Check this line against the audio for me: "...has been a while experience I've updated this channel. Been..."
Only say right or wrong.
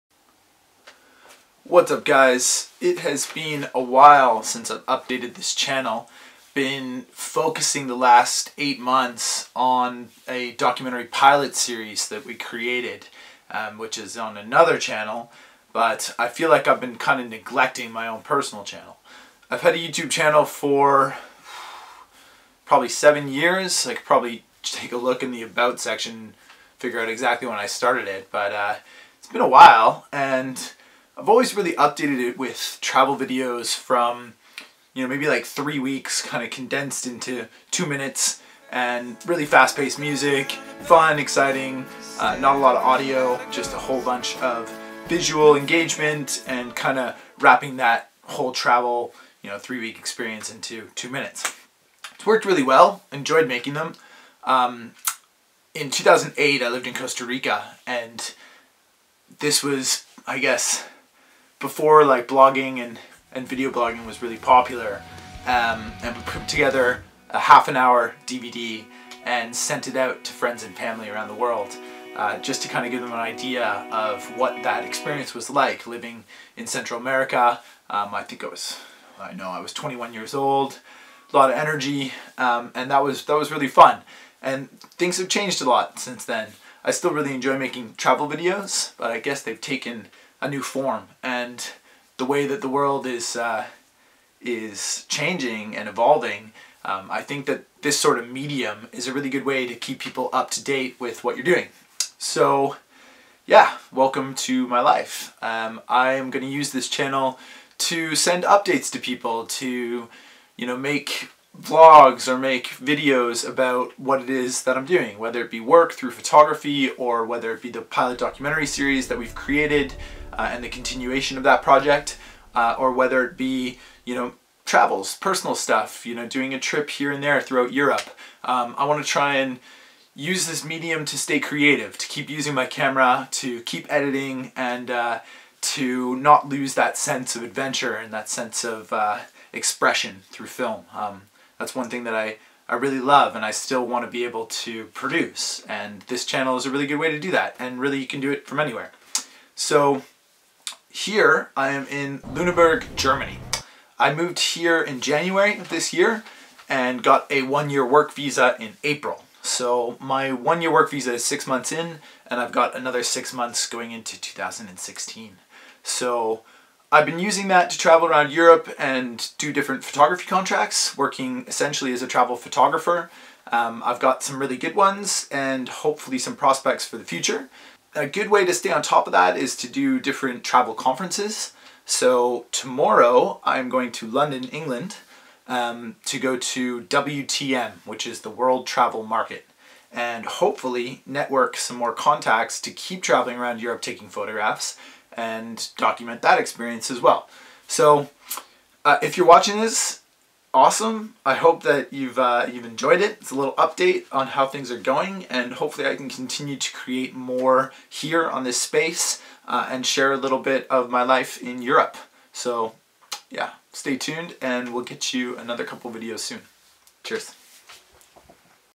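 wrong.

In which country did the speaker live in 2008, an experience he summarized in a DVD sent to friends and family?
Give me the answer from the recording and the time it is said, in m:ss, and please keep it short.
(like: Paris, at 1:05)
Costa Rica, at 0:56.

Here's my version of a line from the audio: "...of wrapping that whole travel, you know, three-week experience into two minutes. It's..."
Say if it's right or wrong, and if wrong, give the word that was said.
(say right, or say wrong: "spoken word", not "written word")
right.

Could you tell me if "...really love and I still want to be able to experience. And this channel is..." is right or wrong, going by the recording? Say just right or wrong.
wrong.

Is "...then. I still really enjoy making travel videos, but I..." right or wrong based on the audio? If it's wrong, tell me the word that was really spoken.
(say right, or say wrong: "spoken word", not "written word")
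right.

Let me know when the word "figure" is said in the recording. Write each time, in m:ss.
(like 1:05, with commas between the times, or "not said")
0:26.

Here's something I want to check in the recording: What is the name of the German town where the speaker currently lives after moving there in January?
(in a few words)
Lüneburg.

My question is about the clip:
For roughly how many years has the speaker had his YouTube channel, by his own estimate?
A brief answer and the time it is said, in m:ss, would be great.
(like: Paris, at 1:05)
7, at 0:22.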